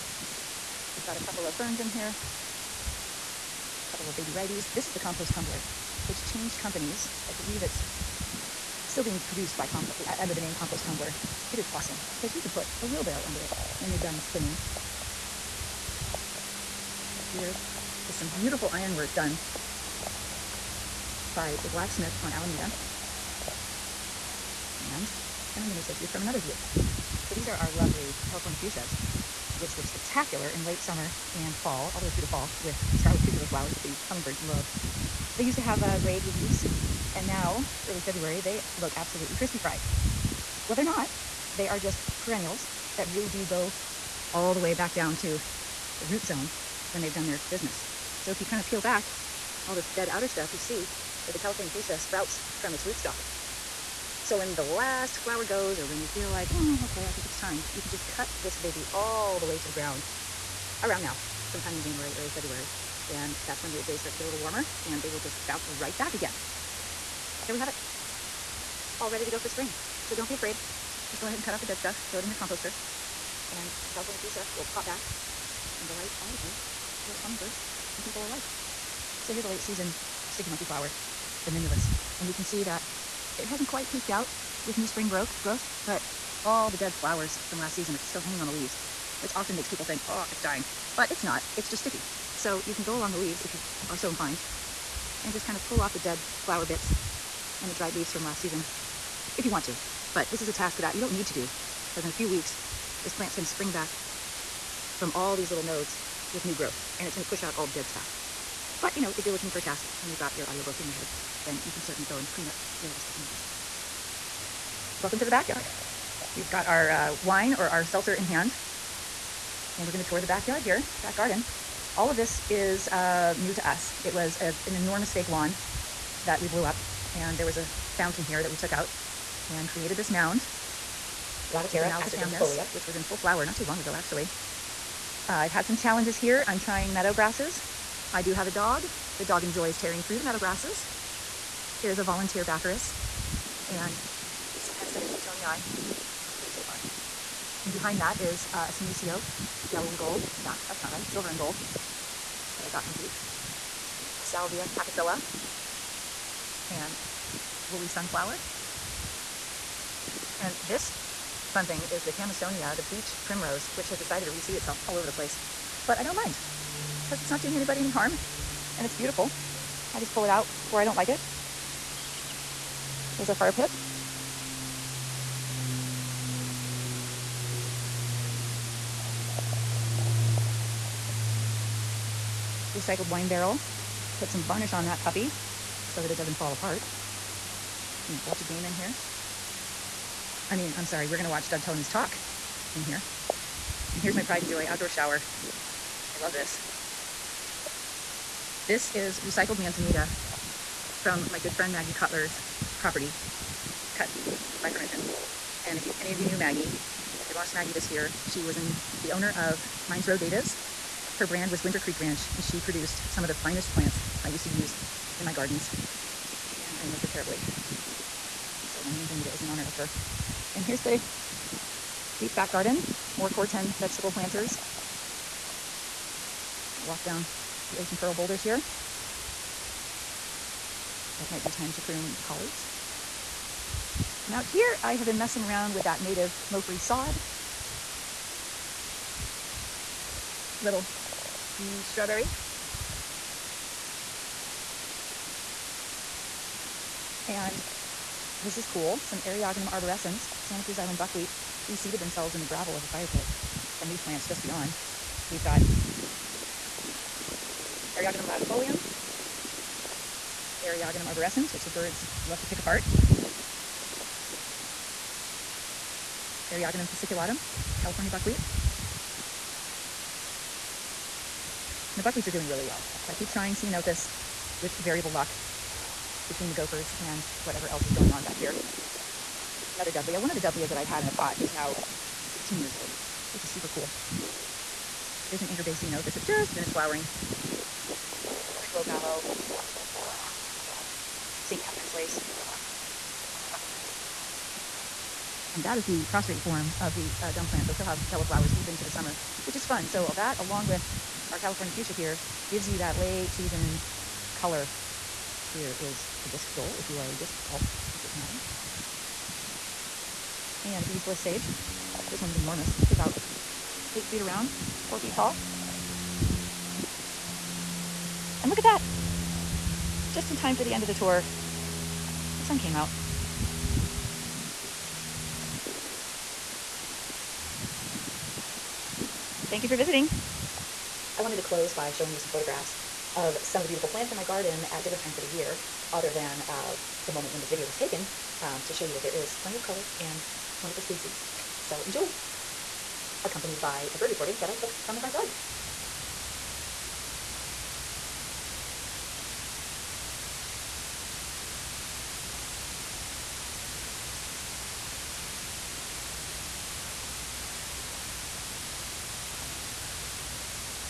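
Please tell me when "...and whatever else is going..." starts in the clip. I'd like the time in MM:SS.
04:36.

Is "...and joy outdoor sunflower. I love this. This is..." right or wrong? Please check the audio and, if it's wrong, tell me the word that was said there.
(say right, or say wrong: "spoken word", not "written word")
wrong: "shower", not "sunflower".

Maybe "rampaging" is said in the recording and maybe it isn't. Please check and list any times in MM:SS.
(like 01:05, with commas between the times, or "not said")
not said.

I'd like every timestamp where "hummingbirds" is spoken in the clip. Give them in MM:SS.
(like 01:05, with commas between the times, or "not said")
00:34, 01:17.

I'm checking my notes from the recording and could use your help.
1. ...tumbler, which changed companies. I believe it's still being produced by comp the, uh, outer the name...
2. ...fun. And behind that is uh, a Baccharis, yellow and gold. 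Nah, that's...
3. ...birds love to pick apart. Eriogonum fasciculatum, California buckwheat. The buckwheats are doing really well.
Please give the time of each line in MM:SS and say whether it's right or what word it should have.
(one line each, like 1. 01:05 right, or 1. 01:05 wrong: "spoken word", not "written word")
1. 00:05 wrong: "under", not "outer"
2. 02:26 wrong: "Senecio", not "Baccharis"
3. 04:21 right.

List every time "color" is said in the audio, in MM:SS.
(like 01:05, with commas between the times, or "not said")
05:04, 05:39.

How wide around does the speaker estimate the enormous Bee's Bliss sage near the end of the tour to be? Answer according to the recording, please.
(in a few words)
8 feet.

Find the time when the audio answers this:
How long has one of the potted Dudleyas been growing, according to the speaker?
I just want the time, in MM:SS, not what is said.
04:42.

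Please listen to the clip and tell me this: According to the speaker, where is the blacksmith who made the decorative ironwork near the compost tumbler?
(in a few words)
Alameda.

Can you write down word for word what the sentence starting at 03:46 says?
I'll walk down the ocean pearl boulders here.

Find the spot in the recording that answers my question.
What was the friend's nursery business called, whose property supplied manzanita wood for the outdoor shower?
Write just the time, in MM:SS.
03:29.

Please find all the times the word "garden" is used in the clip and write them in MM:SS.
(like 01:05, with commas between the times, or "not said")
02:01, 03:35, 03:42, 05:34.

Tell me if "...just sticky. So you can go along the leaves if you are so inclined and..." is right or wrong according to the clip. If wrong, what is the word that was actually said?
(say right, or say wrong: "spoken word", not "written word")
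right.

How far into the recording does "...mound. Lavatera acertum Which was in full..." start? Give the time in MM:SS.
02:10.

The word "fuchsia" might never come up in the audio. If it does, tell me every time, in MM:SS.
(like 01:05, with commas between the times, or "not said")
00:28, 00:51, 01:14, 05:01.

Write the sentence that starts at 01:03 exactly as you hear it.
And that's when the days start to get a little warmer and they will just bounce right back again.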